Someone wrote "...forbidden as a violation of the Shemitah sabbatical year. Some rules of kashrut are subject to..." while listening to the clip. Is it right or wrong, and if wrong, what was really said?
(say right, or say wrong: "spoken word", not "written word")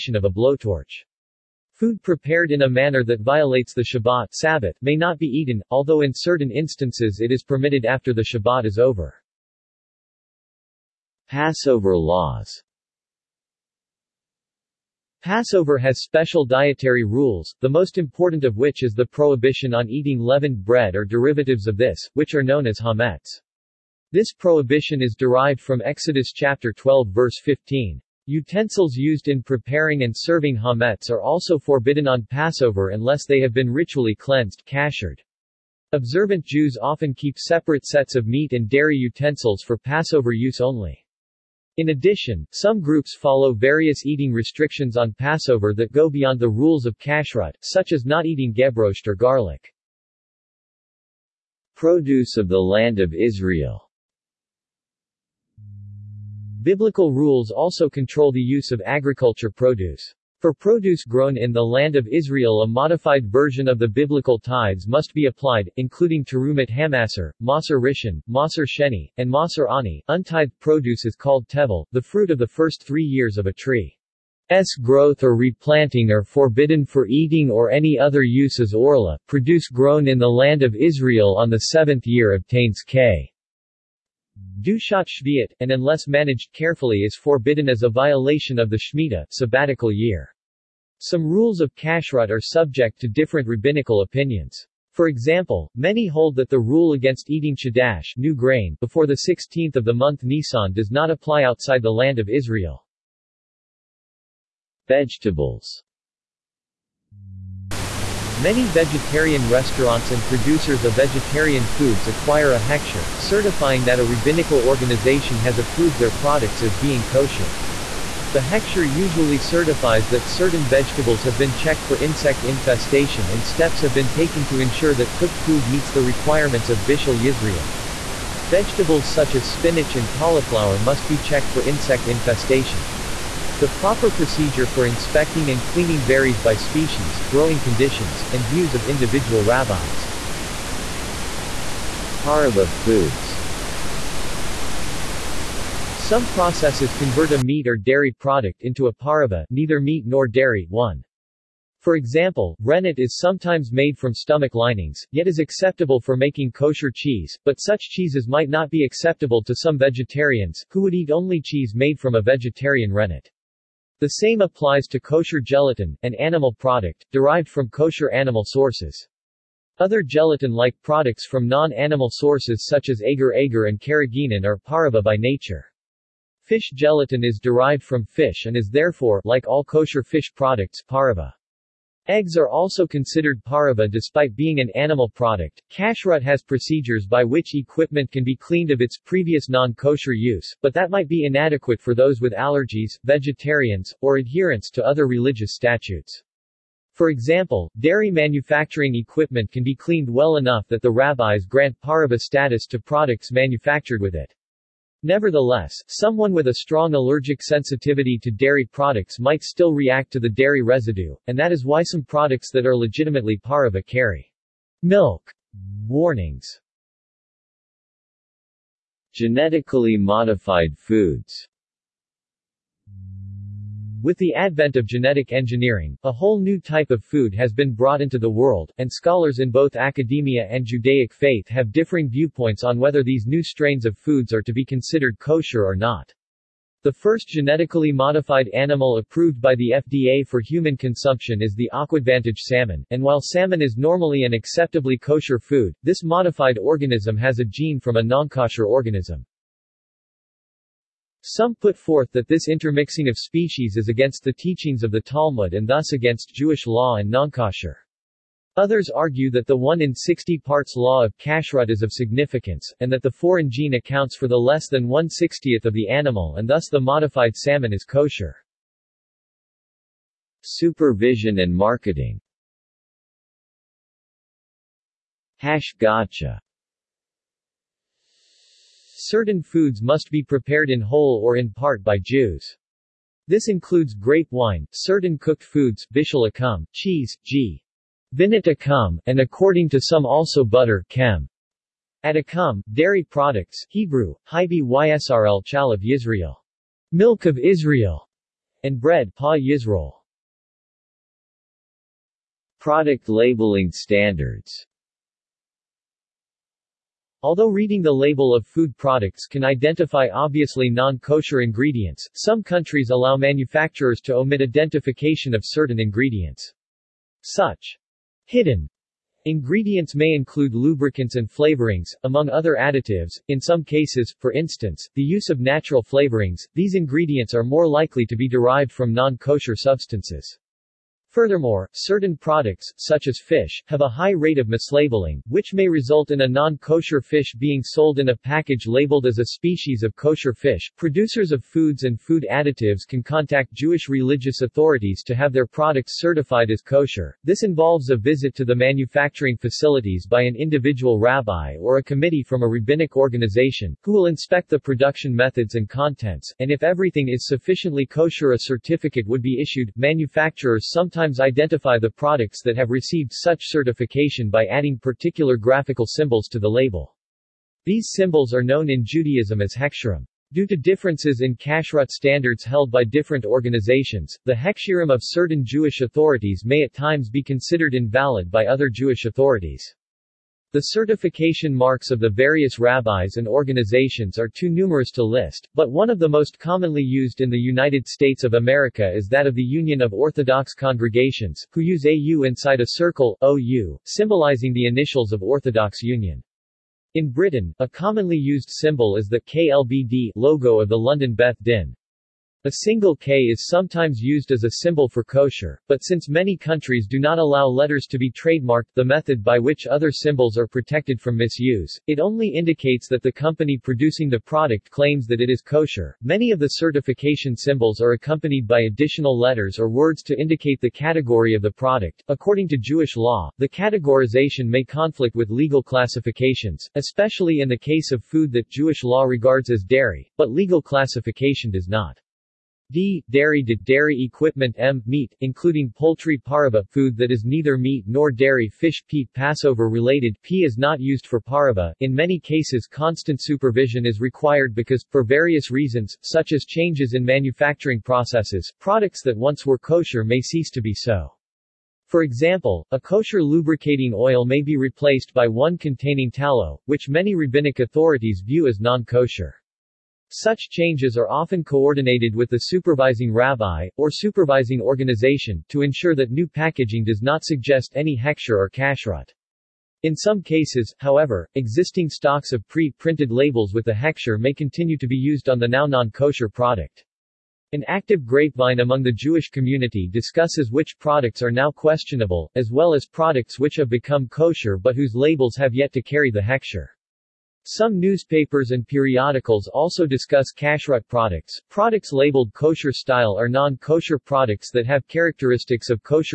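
right.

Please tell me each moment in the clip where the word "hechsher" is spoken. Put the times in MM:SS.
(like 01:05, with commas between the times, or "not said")
01:52, 01:58.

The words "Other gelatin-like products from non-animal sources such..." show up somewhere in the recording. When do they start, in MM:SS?
02:49.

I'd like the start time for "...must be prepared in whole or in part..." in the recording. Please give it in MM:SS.
04:39.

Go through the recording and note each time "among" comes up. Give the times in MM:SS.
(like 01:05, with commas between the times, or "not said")
05:22, 07:58.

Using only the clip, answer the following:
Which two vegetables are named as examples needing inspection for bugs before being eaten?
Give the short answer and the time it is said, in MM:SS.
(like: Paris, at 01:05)
spinach and cauliflower, at 02:09.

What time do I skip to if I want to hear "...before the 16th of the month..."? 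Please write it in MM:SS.
01:38.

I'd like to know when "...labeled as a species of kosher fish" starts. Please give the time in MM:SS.
05:38.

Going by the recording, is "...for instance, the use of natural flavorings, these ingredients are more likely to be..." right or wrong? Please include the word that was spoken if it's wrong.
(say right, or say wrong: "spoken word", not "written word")
right.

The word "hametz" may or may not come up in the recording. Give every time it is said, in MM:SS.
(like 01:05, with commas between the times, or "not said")
00:22, 00:30.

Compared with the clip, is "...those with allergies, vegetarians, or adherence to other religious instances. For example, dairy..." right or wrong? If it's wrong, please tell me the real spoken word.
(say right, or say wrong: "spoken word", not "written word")
wrong: "statutes", not "instances".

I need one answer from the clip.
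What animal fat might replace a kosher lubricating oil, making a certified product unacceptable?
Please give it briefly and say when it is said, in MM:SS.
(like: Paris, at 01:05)
tallow, at 07:36.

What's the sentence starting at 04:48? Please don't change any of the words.
vinet akum, and according to some also butter, kem.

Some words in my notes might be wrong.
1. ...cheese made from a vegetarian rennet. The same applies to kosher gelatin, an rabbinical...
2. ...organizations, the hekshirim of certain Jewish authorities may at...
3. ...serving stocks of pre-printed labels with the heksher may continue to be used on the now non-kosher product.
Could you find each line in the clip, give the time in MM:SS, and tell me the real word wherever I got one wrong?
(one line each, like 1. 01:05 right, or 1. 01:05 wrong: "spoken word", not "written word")
1. 02:41 wrong: "animal", not "rabbinical"
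2. 06:13 right
3. 07:51 wrong: "existing", not "serving".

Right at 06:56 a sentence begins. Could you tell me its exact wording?
Many of the certification symbols are accompanied by additional letters or words to indicate the category of the product.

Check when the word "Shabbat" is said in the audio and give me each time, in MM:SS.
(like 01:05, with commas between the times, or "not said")
00:03, 00:08.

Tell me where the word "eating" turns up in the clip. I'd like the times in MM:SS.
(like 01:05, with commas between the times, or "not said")
00:19, 00:44, 00:48, 01:17, 01:37.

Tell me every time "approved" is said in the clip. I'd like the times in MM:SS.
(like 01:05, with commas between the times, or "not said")
01:55, 03:58.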